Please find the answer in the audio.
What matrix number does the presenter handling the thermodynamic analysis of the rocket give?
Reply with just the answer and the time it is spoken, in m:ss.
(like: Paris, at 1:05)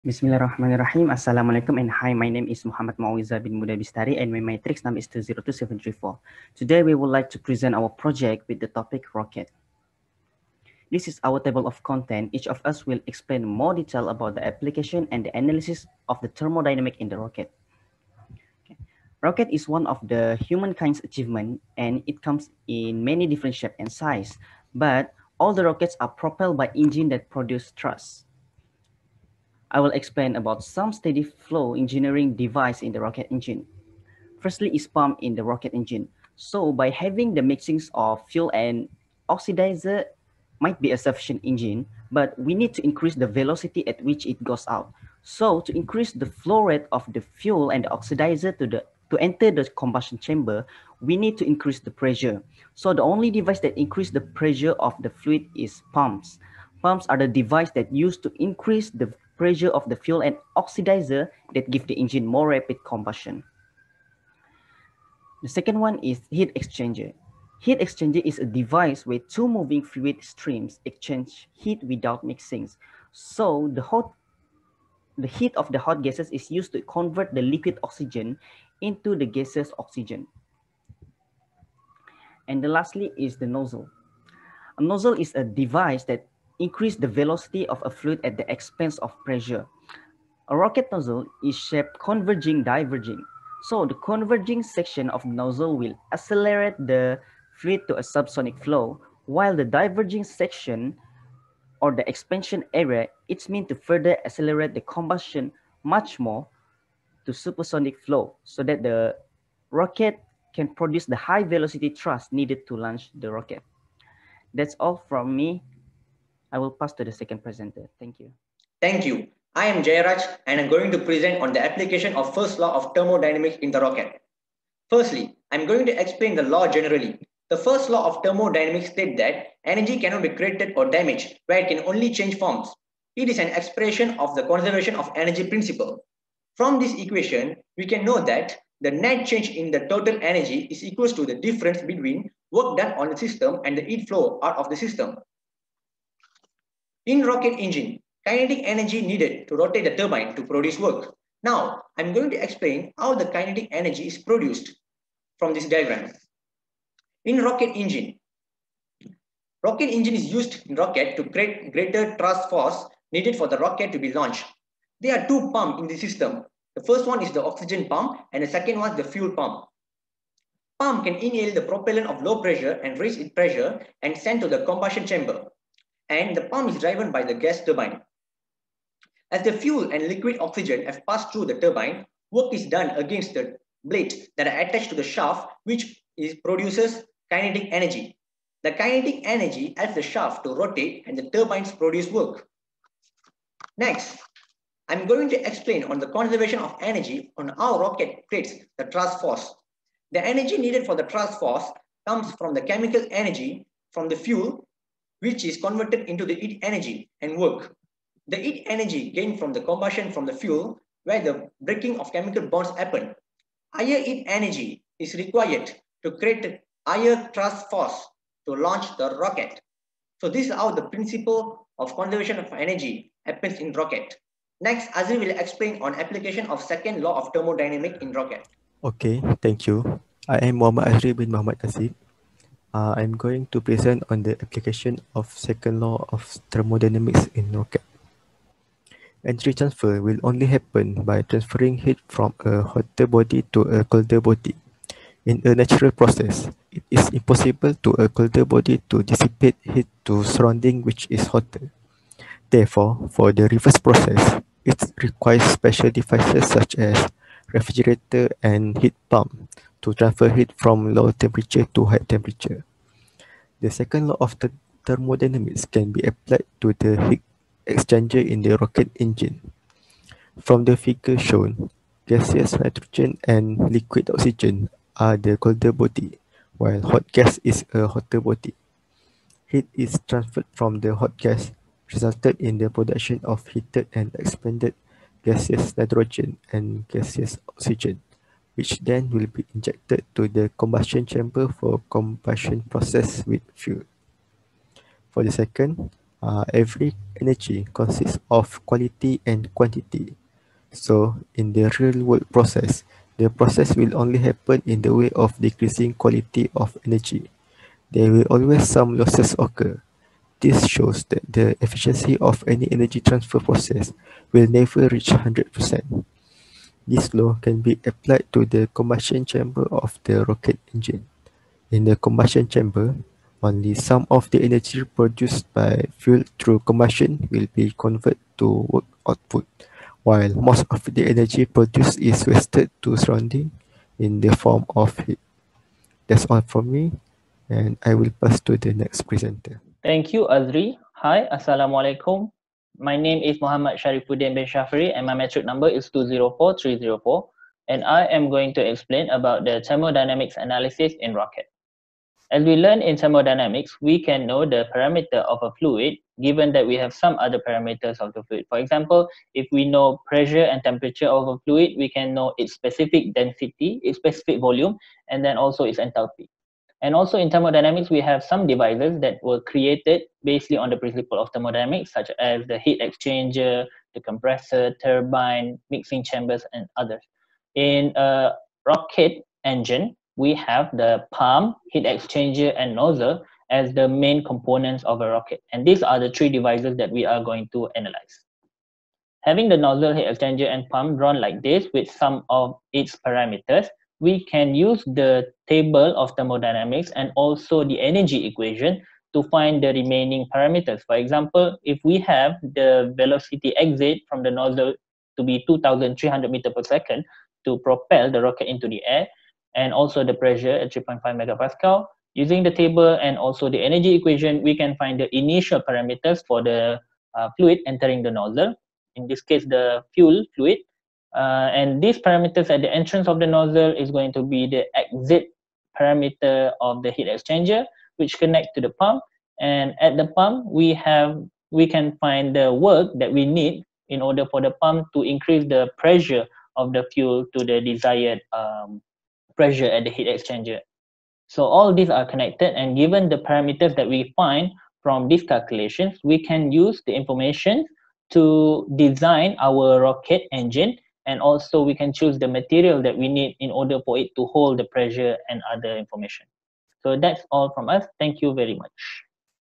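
204304, at 5:45.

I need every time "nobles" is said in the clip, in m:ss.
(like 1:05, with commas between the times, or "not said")
not said.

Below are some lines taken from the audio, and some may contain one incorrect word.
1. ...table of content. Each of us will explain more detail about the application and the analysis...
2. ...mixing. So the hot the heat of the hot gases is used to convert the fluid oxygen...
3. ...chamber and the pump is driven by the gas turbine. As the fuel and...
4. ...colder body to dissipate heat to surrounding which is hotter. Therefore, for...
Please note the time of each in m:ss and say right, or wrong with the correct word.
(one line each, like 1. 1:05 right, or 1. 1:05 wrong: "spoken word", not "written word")
1. 0:11 right
2. 1:12 wrong: "liquid", not "fluid"
3. 2:55 right
4. 4:08 right.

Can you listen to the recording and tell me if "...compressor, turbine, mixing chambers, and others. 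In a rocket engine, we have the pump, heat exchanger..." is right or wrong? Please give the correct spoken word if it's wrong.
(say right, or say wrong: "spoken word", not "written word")
right.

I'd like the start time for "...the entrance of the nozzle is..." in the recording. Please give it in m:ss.
7:02.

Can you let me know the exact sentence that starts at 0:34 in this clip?
Firstly is pump in the rocket engine.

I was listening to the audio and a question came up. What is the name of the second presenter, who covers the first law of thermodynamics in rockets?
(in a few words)
Jayaraj.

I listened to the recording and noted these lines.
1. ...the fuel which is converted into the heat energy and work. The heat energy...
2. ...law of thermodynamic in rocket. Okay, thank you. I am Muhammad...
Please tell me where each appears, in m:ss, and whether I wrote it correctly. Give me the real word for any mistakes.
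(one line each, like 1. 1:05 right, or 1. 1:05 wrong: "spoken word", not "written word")
1. 3:24 right
2. 3:47 right.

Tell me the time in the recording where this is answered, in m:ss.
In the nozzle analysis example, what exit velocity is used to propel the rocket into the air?
6:45.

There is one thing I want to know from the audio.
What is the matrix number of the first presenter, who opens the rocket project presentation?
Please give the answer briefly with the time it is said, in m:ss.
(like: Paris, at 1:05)
202734, at 0:05.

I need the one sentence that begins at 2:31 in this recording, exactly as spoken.
Now, I'm going to explain how the kinetic energy is produced from this diagram.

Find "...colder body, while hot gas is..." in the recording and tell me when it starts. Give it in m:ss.
4:35.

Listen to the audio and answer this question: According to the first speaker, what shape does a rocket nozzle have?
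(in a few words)
Converging diverging.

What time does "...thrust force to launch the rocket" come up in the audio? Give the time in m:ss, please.
3:37.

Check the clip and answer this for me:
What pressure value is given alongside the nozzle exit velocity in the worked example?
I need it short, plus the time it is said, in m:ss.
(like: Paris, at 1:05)
3.5 MPa, at 6:50.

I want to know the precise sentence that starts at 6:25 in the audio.
And these are the three devices that we are going to analyze.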